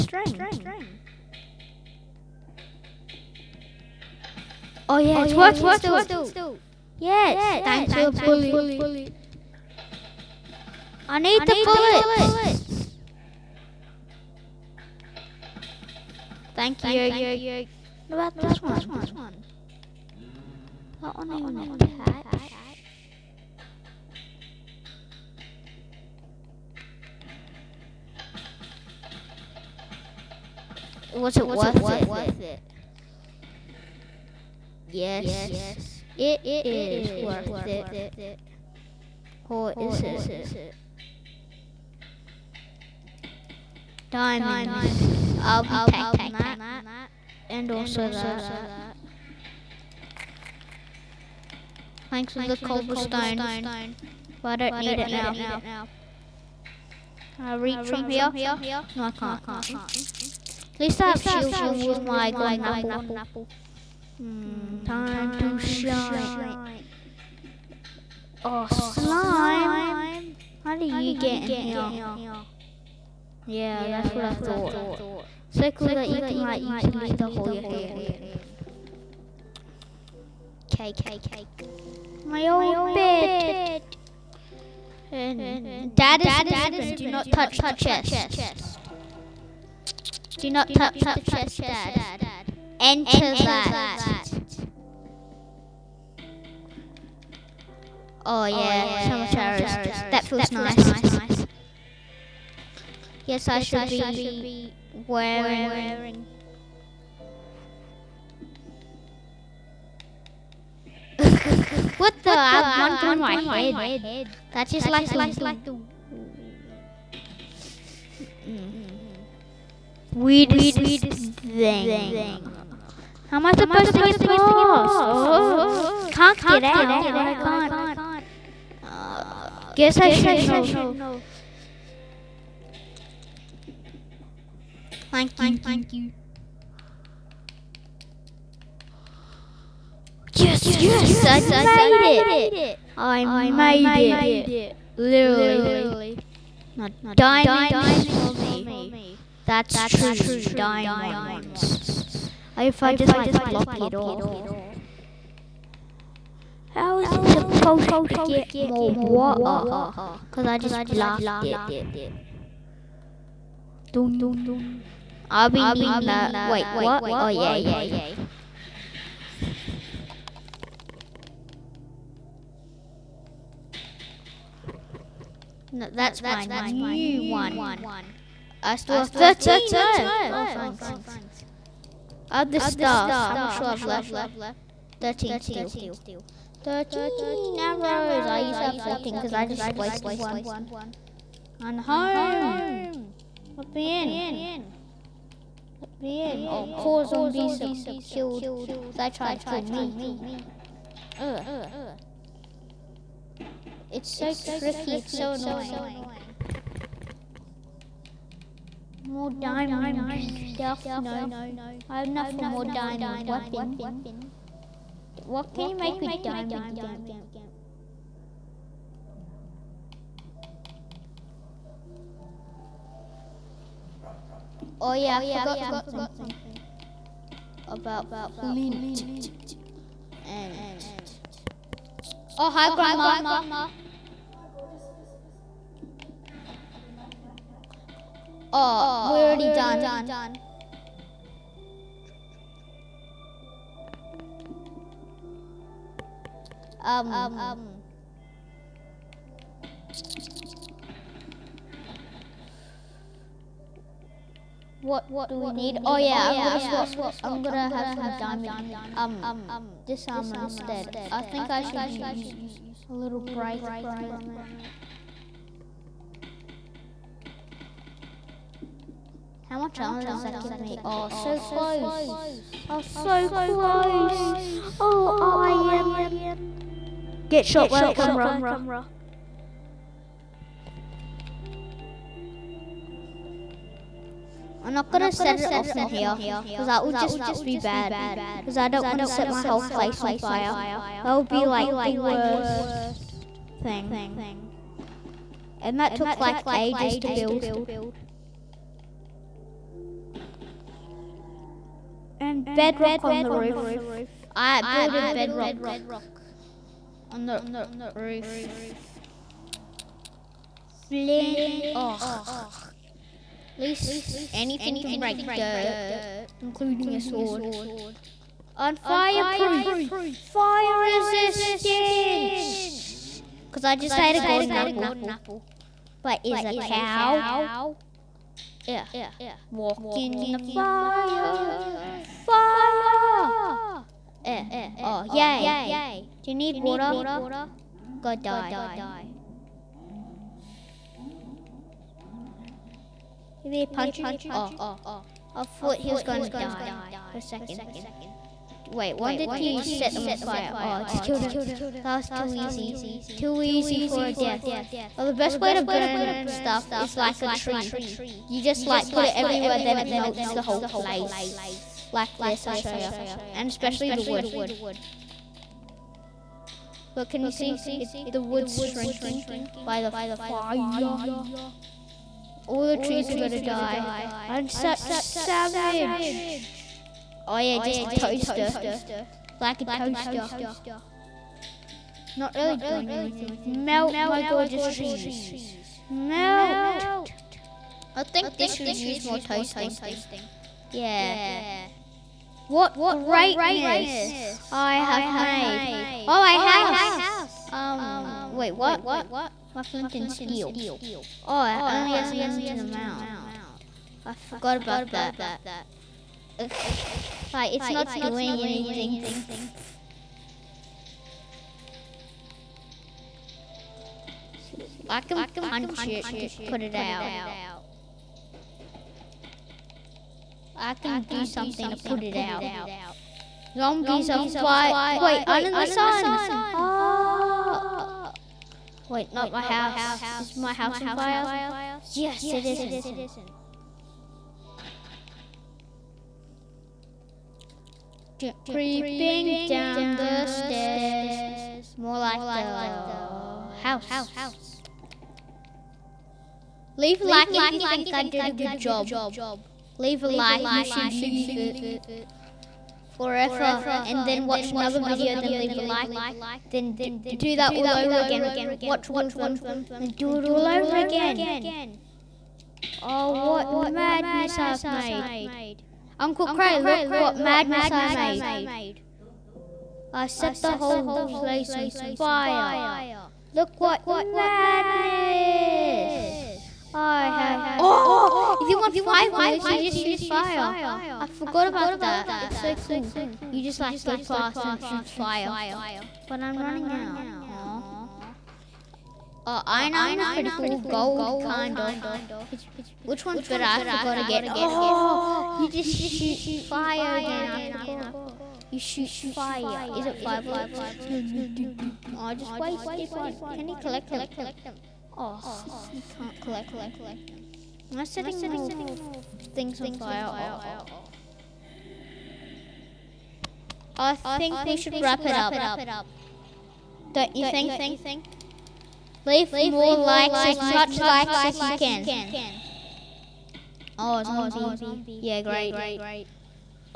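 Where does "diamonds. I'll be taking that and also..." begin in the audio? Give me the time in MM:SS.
00:44.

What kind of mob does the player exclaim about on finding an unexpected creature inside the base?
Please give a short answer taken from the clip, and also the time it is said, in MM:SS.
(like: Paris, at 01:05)
slime, at 01:08.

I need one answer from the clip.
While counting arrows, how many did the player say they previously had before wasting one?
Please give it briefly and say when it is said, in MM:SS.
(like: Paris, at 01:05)
14, at 03:08.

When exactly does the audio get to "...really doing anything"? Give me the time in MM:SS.
06:22.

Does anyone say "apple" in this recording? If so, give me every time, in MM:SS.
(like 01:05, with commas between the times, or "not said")
01:02, 05:24.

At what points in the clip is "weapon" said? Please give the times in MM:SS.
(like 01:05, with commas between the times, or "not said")
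03:33.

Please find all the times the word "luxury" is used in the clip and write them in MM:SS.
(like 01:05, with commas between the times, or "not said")
not said.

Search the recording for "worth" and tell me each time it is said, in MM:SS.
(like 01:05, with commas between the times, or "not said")
00:31, 00:37.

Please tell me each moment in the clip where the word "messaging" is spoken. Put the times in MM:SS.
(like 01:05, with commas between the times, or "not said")
not said.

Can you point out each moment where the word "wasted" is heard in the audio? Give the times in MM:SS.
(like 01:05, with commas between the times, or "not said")
03:09, 08:22.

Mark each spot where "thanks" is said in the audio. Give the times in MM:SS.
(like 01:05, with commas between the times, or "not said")
00:07, 00:16, 00:52, 02:15, 03:00.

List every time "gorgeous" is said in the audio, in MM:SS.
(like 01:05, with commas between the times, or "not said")
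06:24.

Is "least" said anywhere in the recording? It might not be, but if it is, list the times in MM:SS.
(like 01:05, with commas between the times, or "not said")
01:00, 05:13.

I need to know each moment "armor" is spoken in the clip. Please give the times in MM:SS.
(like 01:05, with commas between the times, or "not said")
04:20, 04:29, 08:09.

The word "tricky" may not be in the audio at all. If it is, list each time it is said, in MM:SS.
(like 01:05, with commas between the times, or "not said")
03:24.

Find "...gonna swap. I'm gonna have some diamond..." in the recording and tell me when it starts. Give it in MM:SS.
04:16.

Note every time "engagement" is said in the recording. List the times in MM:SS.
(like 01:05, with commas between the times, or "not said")
not said.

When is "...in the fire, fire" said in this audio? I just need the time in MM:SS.
05:29.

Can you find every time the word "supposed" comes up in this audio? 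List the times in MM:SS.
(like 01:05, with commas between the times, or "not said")
02:03, 02:37.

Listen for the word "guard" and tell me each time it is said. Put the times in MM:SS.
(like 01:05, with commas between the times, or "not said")
not said.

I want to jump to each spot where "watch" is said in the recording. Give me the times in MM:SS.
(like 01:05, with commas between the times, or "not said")
07:34, 07:38.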